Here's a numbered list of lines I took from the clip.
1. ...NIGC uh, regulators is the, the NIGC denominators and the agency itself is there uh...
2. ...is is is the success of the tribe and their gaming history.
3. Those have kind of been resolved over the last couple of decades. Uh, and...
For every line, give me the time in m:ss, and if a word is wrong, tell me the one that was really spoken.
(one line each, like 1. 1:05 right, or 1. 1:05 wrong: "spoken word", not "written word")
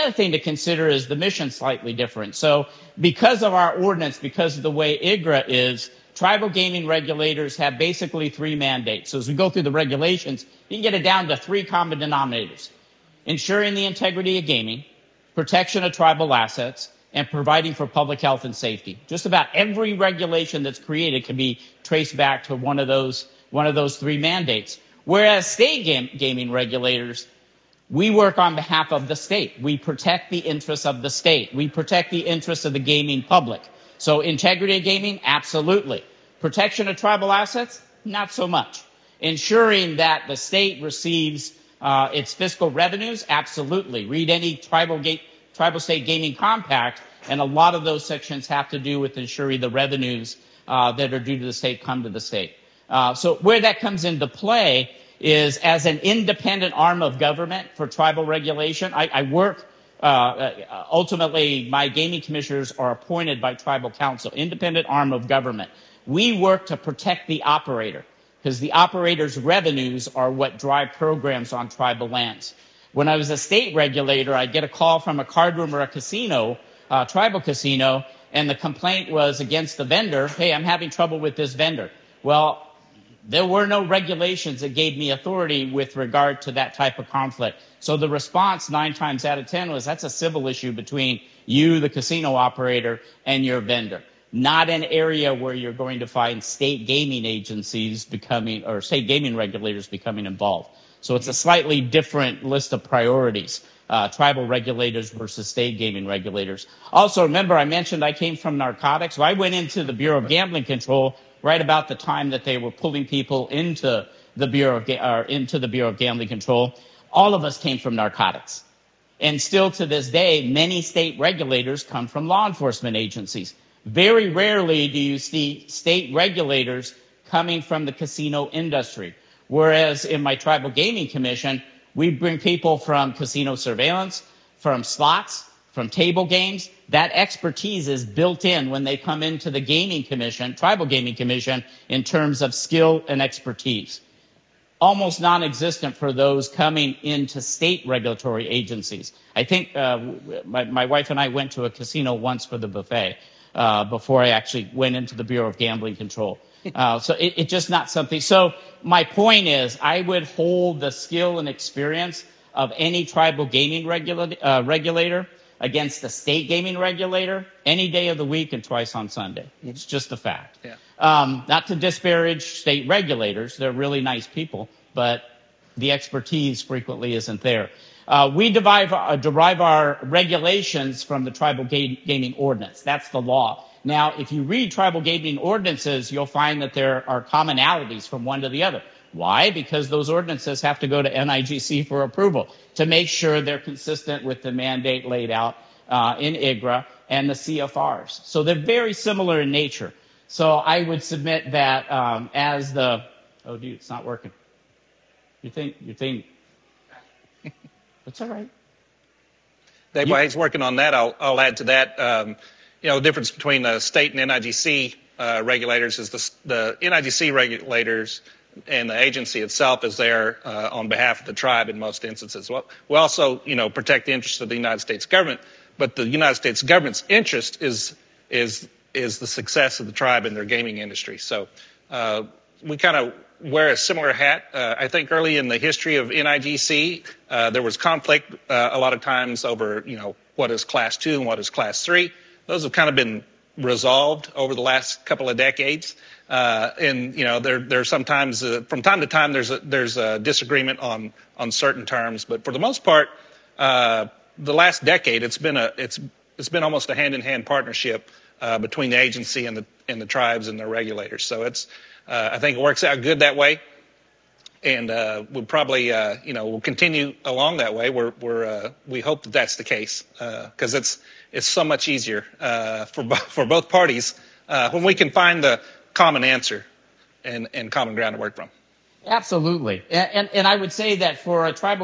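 1. 3:34 wrong: "regulators", not "denominators"
2. 3:47 wrong: "industry", not "history"
3. 4:02 right.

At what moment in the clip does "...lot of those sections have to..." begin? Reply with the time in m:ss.
0:47.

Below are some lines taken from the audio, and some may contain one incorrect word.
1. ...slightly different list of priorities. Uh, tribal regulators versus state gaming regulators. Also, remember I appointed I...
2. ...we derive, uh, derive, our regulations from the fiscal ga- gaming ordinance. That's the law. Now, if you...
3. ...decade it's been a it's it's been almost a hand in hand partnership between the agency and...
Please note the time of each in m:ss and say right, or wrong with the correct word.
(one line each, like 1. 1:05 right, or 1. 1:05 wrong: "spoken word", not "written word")
1. 1:41 wrong: "mentioned", not "appointed"
2. 2:58 wrong: "tribal", not "fiscal"
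3. 4:14 right.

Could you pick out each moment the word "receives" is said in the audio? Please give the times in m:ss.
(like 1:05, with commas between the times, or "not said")
0:40.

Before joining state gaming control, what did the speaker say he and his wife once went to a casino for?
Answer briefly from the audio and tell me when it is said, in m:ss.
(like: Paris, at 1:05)
The buffet, at 2:32.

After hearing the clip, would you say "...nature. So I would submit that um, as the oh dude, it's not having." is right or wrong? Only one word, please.
wrong.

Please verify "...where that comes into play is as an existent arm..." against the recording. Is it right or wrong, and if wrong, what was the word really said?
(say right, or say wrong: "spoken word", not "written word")
wrong: "independent", not "existent".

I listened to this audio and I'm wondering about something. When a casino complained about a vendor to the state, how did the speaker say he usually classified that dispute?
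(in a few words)
A civil issue.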